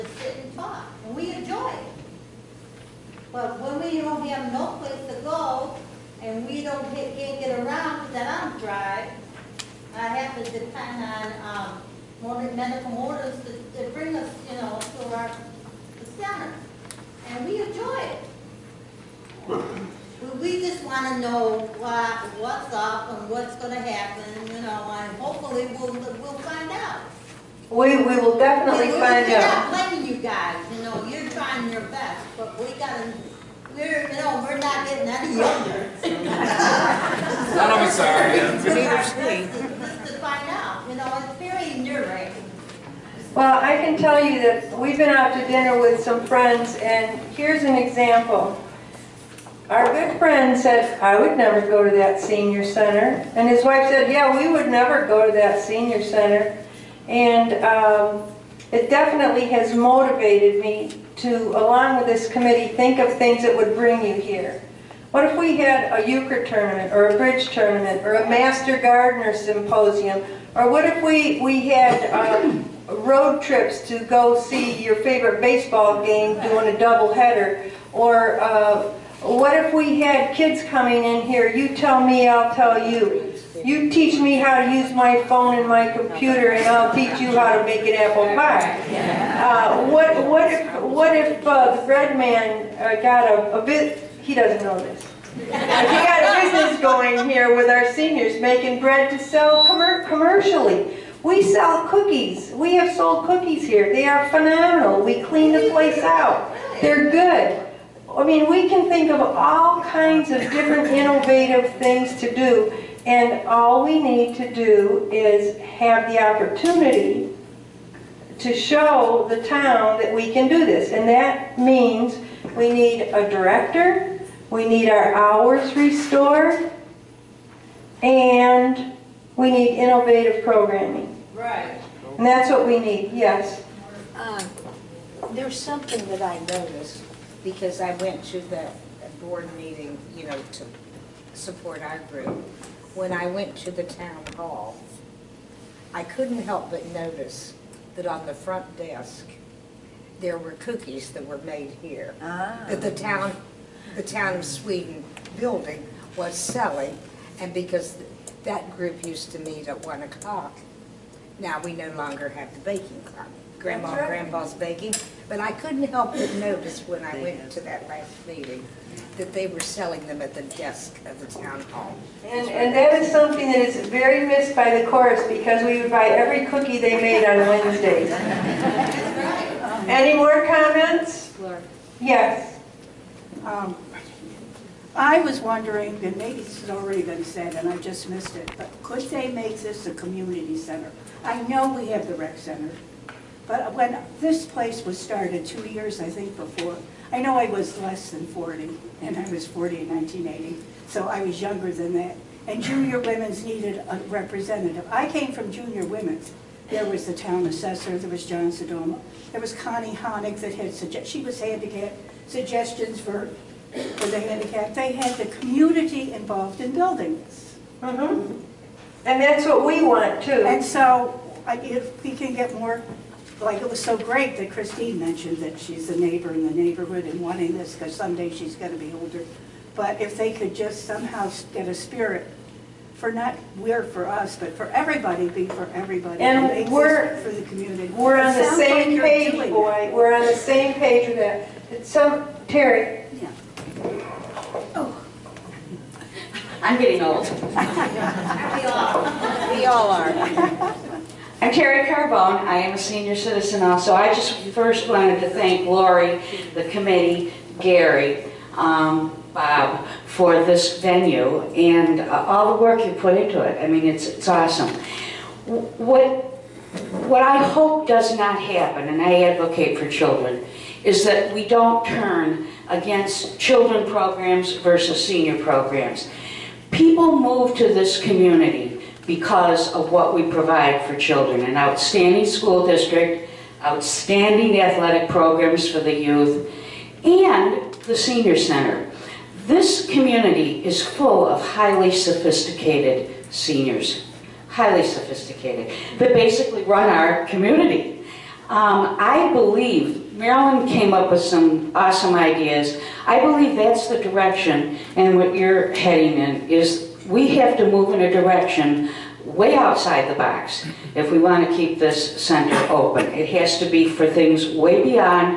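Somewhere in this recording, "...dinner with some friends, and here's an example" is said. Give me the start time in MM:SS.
00:45.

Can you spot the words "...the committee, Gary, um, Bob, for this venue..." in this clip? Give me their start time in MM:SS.
04:16.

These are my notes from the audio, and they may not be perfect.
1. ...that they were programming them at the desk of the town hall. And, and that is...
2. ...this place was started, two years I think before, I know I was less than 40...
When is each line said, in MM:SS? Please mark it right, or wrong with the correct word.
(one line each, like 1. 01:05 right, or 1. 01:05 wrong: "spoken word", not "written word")
1. 02:49 wrong: "selling", not "programming"
2. 03:14 right.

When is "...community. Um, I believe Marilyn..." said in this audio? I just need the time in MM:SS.
04:57.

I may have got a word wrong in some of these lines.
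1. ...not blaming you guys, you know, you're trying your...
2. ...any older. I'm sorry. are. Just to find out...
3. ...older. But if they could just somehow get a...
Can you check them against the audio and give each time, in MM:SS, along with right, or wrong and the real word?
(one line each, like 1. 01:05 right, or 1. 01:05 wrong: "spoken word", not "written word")
1. 00:29 right
2. 00:35 wrong: "younger", not "older"
3. 03:48 right.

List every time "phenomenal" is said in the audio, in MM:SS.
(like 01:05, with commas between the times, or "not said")
01:44.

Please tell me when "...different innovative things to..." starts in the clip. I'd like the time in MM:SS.
01:50.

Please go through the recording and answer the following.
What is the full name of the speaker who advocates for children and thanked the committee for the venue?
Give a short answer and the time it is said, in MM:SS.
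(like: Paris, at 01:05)
Terry Carbone, at 04:11.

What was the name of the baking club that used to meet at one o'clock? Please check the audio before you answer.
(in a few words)
Grandma and Grandpa's baking.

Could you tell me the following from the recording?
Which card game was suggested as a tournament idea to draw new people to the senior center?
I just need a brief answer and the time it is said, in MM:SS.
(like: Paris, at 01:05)
Euchre, at 01:06.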